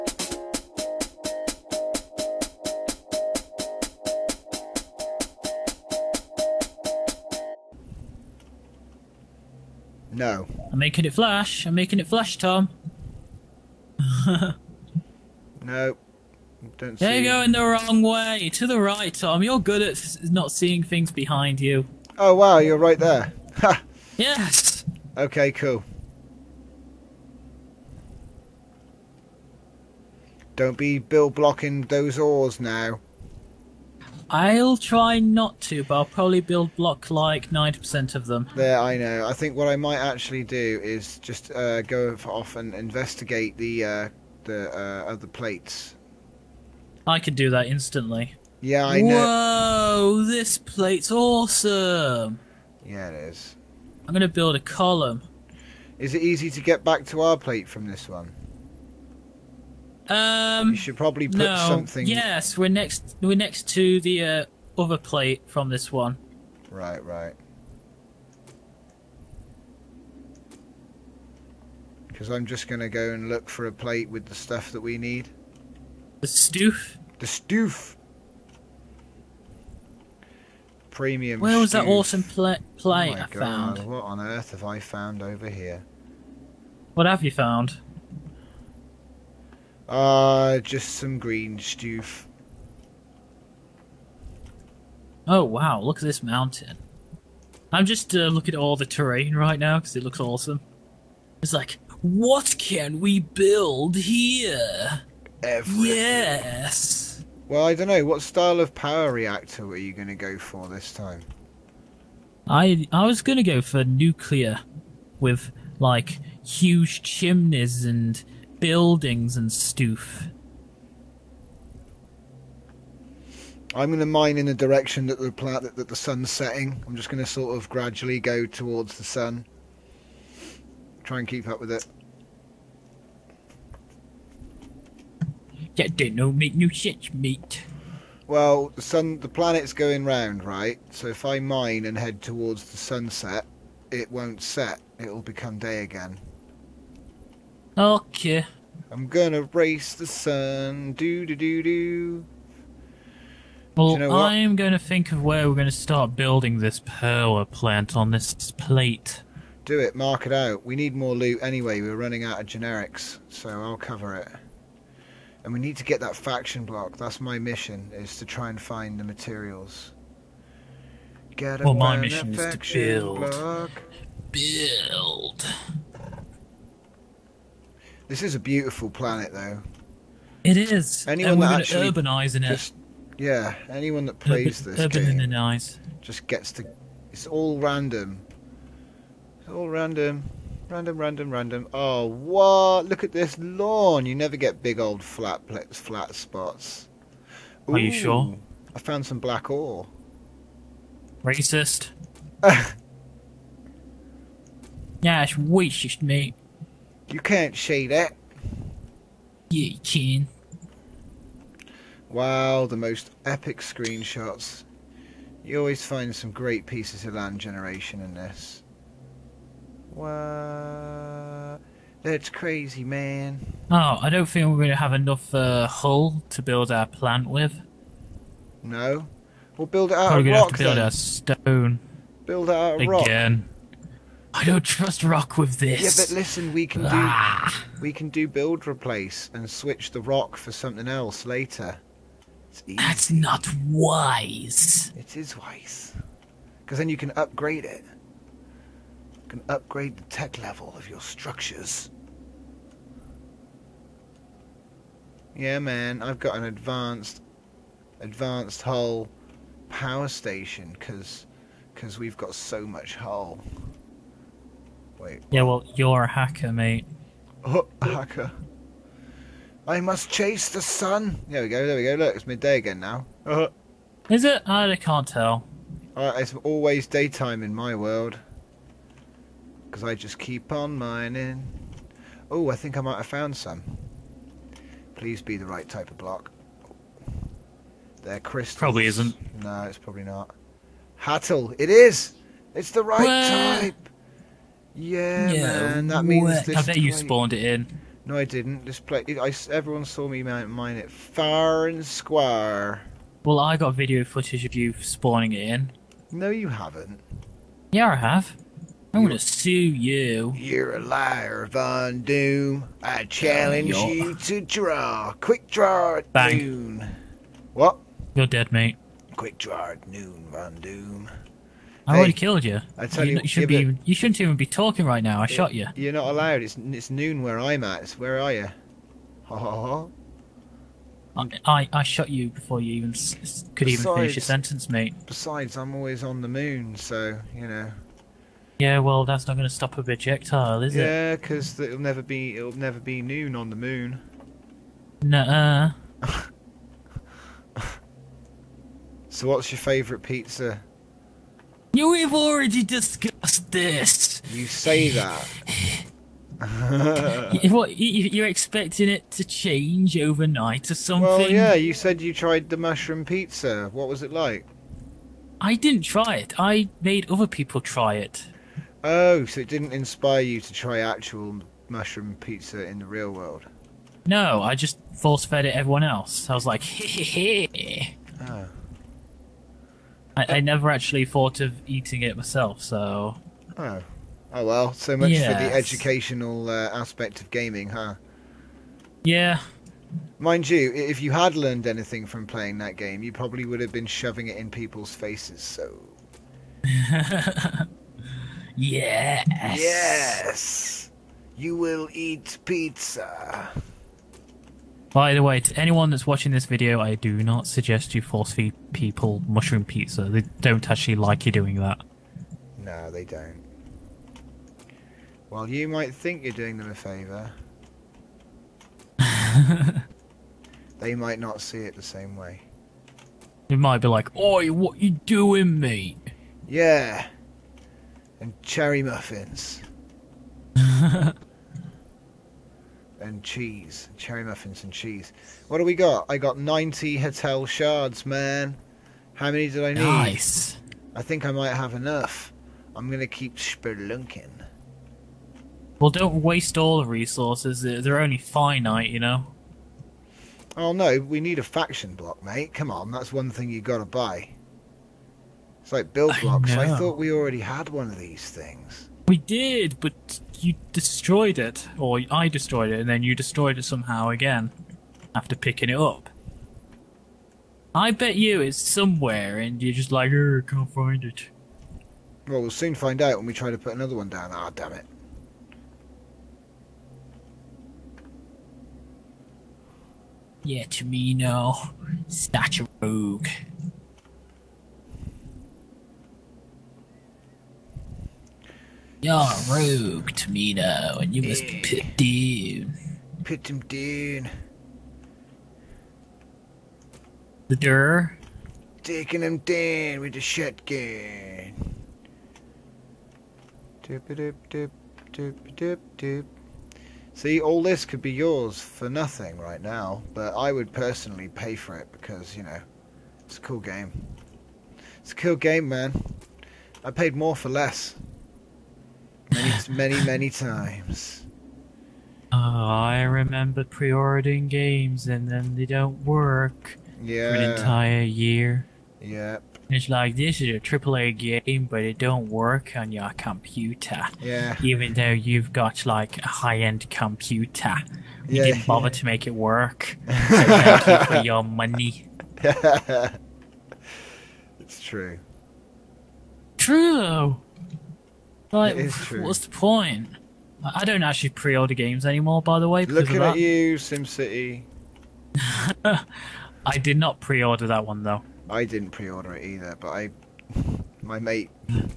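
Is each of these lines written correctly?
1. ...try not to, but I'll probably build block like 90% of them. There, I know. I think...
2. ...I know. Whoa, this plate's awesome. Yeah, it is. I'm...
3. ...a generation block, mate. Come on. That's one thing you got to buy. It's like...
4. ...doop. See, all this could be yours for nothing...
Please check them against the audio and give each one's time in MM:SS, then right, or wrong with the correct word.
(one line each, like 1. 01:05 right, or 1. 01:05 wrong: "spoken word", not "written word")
1. 00:34 right
2. 00:48 right
3. 07:31 wrong: "faction", not "generation"
4. 08:25 right.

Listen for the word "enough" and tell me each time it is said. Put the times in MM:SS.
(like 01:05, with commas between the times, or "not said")
03:44, 07:21.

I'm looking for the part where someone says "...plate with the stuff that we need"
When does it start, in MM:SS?
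01:13.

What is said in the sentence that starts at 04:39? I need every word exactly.
Because I just keep on mining.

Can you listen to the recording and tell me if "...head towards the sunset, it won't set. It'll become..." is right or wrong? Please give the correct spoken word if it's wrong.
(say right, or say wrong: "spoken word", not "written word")
right.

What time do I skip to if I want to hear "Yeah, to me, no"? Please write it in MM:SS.
08:00.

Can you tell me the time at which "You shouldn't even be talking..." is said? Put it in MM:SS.
05:23.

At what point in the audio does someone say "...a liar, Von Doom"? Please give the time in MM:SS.
05:10.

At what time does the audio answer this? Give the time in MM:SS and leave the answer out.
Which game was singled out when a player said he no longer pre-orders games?
09:13.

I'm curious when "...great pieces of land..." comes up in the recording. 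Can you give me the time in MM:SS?
03:36.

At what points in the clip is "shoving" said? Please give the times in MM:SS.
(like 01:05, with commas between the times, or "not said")
06:33.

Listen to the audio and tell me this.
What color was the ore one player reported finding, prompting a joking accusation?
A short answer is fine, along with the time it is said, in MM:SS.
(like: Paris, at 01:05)
Black, at 03:19.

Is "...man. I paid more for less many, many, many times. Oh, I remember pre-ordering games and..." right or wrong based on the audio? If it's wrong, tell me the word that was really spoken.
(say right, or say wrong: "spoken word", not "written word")
right.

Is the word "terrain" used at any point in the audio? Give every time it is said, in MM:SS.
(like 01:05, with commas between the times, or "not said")
01:38.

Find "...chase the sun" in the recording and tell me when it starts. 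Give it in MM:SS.
04:30.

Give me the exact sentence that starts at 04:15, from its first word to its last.
Yeah, man, I've got an advanced, advanced hull power station because because we've got so much hull.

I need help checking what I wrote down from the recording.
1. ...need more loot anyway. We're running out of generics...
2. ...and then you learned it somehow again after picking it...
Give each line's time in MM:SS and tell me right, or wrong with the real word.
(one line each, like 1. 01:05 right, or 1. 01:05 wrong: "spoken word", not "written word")
1. 02:40 right
2. 07:42 wrong: "destroyed", not "learned".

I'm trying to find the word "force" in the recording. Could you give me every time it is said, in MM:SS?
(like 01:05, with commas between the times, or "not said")
06:14, 06:48.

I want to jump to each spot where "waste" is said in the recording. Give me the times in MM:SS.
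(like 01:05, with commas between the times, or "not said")
07:26.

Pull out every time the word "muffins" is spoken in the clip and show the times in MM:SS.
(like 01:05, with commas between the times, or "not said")
07:08, 07:14.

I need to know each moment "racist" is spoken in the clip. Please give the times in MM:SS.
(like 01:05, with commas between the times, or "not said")
03:21, 03:25.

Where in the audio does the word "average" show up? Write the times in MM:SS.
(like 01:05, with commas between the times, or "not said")
not said.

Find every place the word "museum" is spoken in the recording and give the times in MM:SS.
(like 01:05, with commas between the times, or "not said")
not said.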